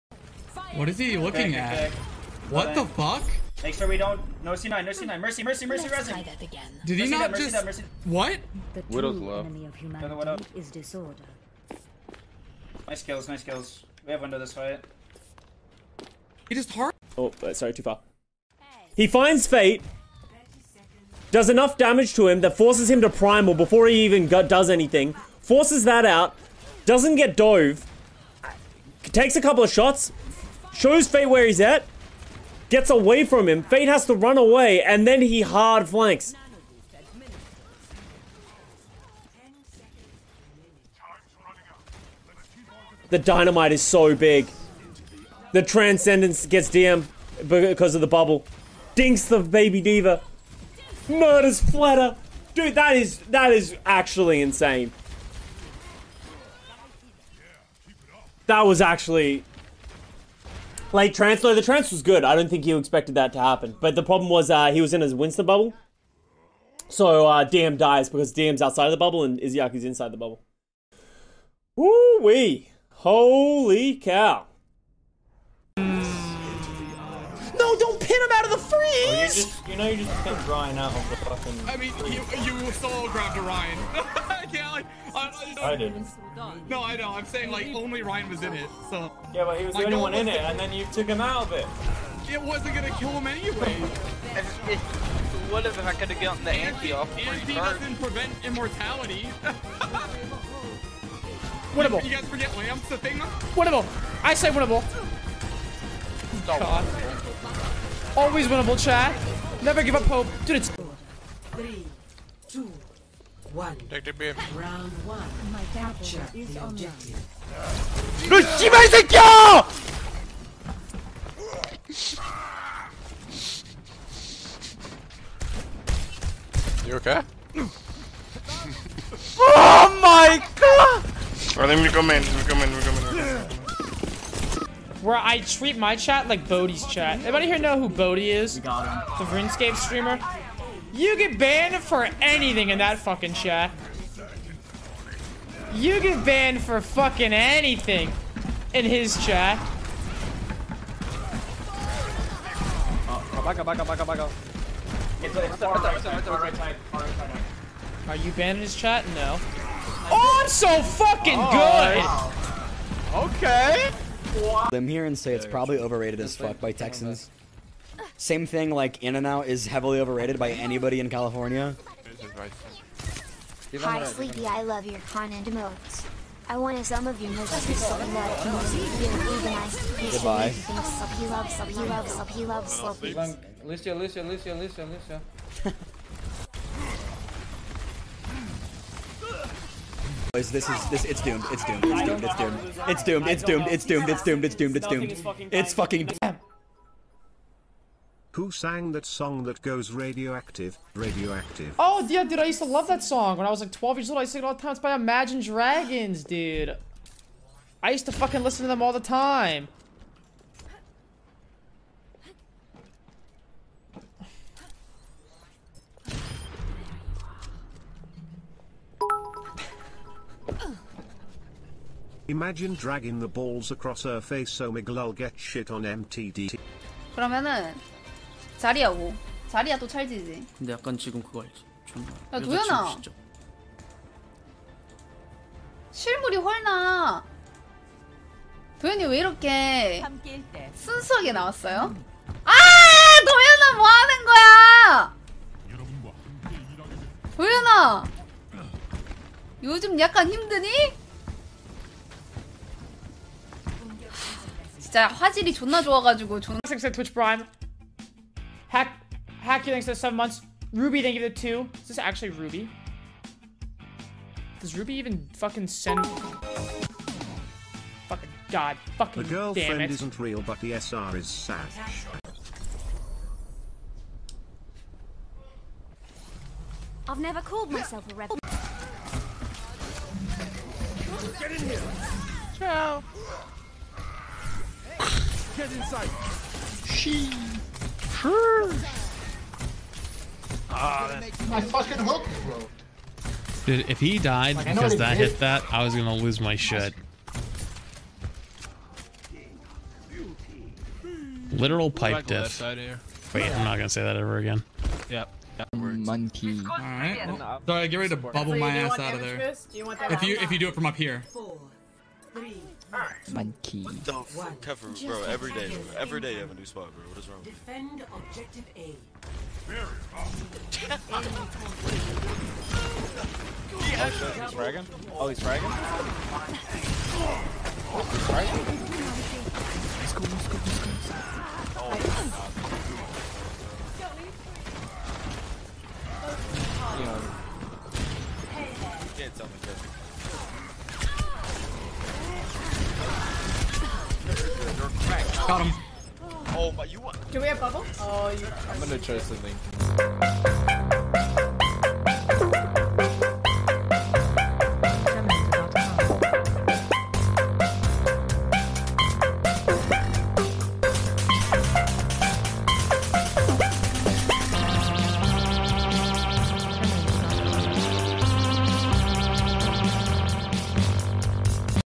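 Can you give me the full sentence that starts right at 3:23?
When I was like 12 years old, I sing it all the time.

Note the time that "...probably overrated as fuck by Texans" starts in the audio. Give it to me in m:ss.
2:45.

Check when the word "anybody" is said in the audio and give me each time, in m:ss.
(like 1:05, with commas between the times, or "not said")
2:17, 2:50.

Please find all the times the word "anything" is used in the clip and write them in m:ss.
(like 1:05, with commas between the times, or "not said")
0:24, 2:22, 2:27.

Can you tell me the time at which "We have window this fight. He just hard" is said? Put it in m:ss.
0:14.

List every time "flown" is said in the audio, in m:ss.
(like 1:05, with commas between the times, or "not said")
not said.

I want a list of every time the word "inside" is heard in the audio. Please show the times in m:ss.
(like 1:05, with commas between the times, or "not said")
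1:09, 4:45.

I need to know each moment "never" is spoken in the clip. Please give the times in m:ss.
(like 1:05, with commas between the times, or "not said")
1:49, 4:37.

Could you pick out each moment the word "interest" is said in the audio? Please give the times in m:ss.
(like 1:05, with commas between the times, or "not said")
not said.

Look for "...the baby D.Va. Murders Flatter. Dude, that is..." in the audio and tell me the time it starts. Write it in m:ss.
0:49.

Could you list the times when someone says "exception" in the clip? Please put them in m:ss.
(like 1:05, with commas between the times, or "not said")
not said.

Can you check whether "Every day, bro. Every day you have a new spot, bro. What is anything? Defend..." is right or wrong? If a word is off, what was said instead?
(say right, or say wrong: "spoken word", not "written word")
wrong: "wrong", not "anything".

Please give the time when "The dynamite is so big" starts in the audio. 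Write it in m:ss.
0:43.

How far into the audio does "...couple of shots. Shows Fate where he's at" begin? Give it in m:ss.
0:29.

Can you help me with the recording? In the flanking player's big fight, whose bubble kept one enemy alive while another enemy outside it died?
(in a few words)
Winston.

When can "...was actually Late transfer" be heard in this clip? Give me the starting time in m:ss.
0:58.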